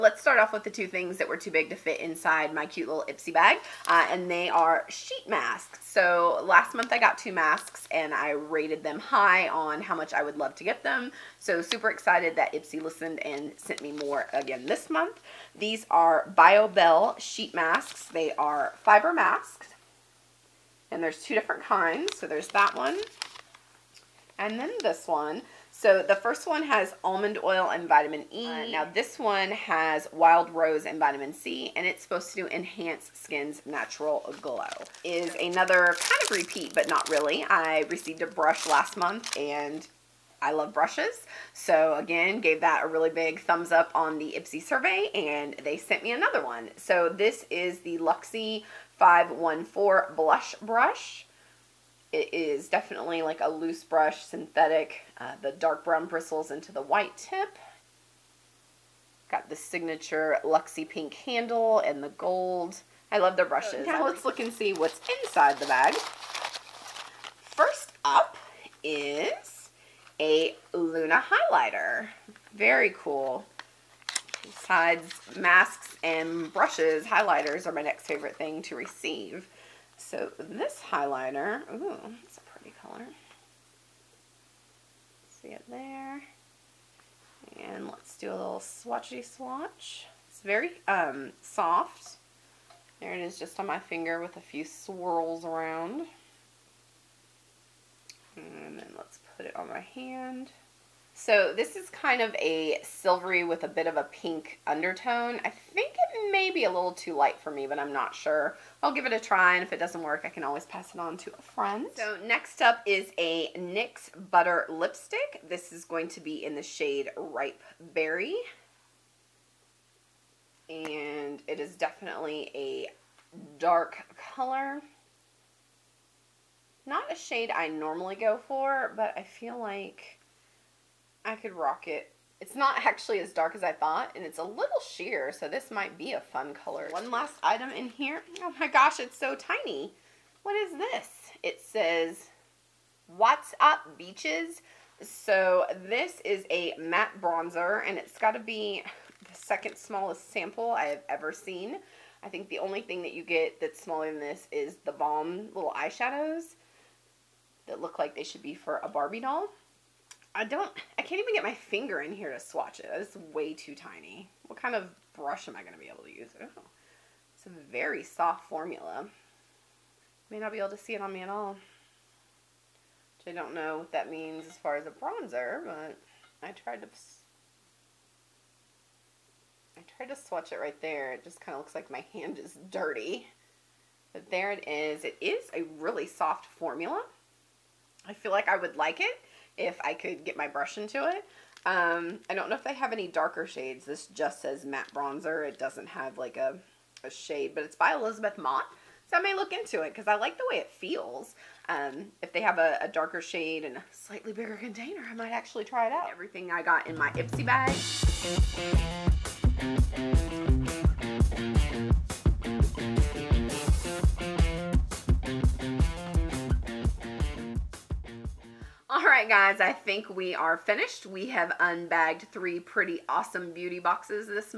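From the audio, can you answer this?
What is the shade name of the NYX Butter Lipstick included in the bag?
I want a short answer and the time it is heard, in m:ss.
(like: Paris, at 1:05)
Ripe Berry, at 1:57.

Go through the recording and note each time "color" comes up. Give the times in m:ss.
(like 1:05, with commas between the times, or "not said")
1:22, 2:04, 2:16.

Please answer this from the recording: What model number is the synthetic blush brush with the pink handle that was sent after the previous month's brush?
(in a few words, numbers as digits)
514.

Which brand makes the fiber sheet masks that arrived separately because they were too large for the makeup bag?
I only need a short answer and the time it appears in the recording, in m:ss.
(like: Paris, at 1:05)
Biobelle, at 0:16.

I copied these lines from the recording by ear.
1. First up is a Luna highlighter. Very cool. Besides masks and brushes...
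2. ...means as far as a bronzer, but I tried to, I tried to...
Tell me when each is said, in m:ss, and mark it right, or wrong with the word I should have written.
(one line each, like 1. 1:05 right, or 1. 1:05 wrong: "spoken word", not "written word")
1. 1:07 right
2. 2:54 right.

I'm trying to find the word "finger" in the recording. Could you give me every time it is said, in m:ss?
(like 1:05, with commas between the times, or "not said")
1:33, 2:41.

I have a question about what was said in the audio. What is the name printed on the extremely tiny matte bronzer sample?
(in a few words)
What's Up Beaches.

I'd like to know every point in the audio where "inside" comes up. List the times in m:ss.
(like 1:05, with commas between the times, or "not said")
0:01, 1:05.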